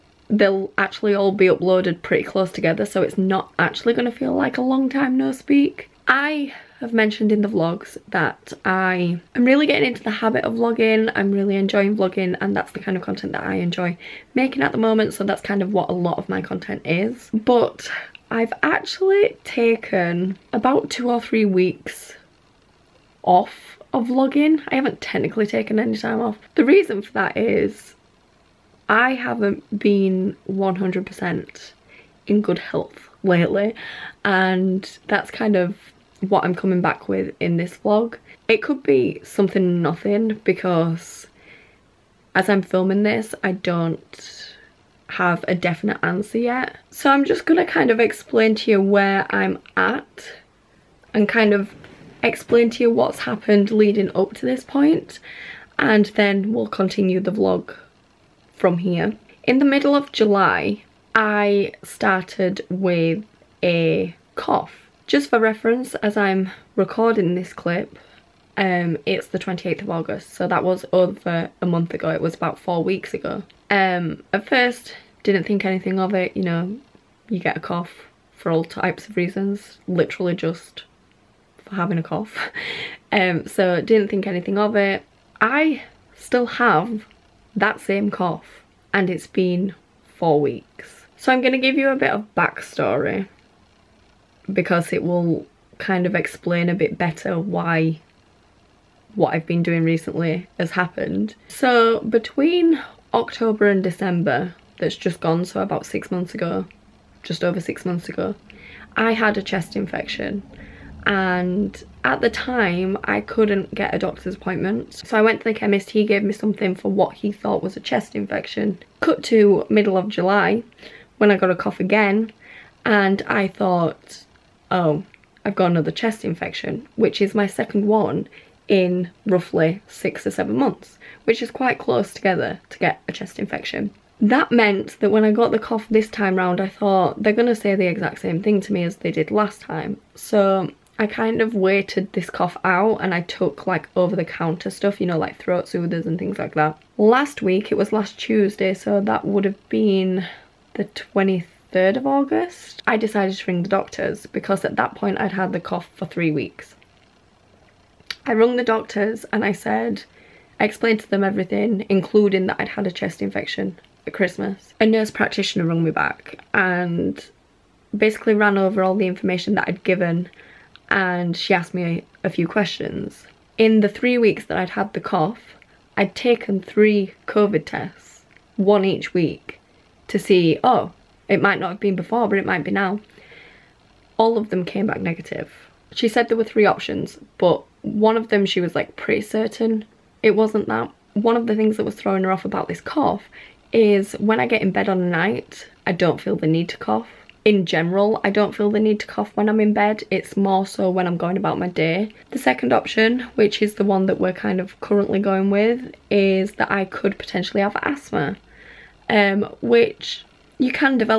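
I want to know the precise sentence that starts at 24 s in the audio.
I haven't technically taken any time off.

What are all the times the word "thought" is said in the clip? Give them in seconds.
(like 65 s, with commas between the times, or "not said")
117 s, 123 s, 136 s.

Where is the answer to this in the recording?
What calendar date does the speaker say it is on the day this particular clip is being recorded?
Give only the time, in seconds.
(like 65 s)
69 s.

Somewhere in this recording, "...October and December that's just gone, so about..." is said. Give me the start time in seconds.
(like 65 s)
103 s.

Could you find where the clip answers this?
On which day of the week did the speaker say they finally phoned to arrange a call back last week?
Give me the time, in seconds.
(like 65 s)
148 s.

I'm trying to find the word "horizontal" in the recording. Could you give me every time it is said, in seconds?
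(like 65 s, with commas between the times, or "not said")
not said.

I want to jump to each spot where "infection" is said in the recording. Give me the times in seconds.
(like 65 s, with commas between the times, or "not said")
109 s, 118 s, 126 s, 133 s, 163 s.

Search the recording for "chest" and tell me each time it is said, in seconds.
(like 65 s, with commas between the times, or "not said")
109 s, 117 s, 125 s, 133 s, 162 s.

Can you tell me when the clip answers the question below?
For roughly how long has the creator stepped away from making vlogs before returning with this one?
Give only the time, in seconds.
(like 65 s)
20 s.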